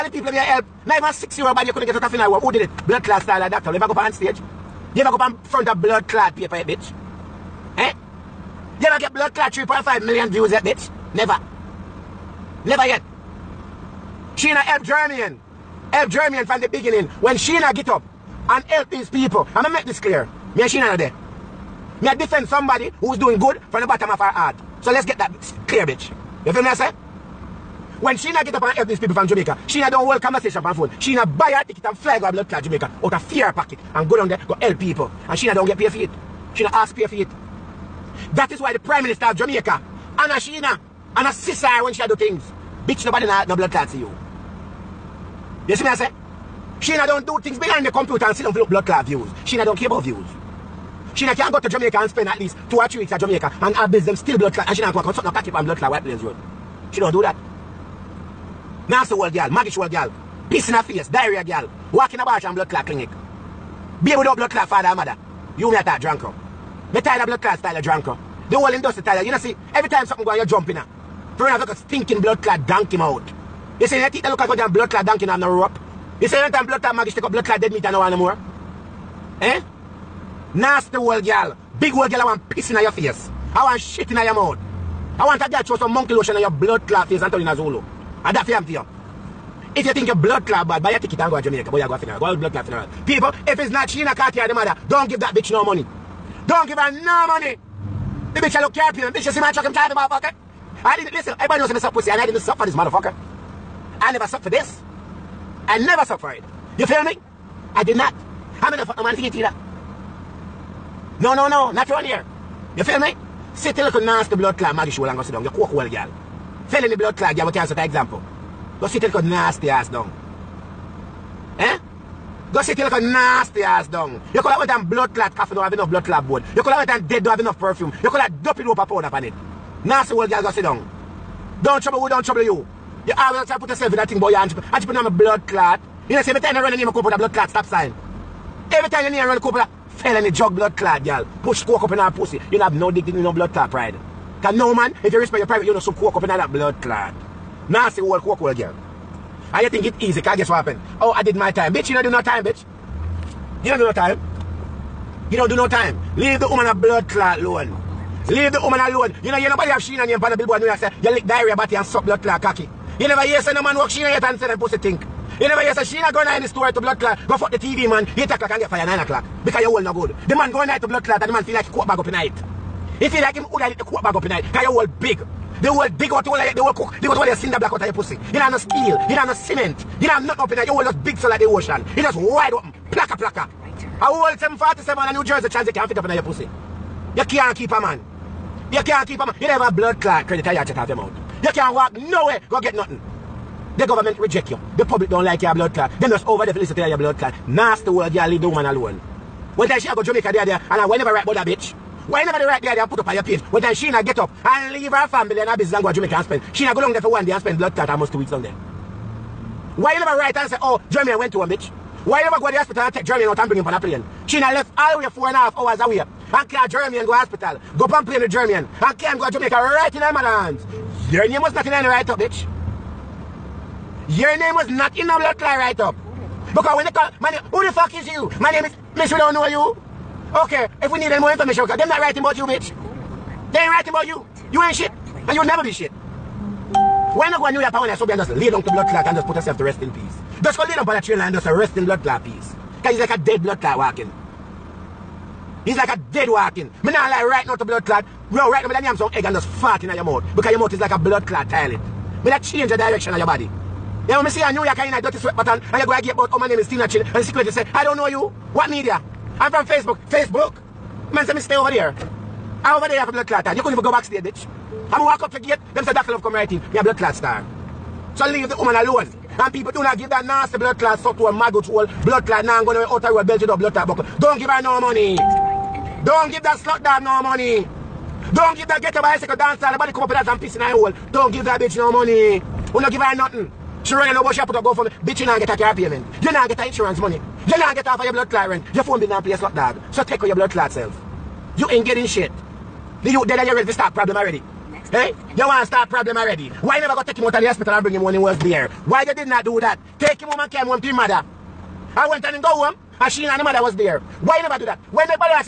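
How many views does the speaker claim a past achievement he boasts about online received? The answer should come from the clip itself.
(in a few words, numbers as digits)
3.5 million.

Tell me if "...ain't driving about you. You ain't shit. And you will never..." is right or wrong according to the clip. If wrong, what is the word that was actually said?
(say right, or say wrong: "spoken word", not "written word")
wrong: "writing", not "driving".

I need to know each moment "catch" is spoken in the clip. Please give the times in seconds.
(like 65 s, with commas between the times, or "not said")
55 s.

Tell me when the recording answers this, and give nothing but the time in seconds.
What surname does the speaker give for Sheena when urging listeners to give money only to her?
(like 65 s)
94 s.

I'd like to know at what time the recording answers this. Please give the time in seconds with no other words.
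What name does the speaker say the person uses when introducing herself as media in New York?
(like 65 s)
256 s.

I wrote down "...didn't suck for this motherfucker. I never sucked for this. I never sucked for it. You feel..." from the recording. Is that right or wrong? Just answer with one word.
right.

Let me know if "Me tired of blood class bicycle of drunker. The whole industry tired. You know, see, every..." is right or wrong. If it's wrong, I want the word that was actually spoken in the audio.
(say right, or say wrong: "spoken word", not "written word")
wrong: "style", not "bicycle".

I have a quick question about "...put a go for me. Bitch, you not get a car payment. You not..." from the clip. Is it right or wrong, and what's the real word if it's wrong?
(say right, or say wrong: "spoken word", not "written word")
right.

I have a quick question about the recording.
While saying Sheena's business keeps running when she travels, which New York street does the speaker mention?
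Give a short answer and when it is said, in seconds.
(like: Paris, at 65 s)
White Plains Road, at 55 s.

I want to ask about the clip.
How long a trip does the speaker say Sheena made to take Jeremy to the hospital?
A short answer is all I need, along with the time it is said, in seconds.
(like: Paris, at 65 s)
four and a half hours, at 215 s.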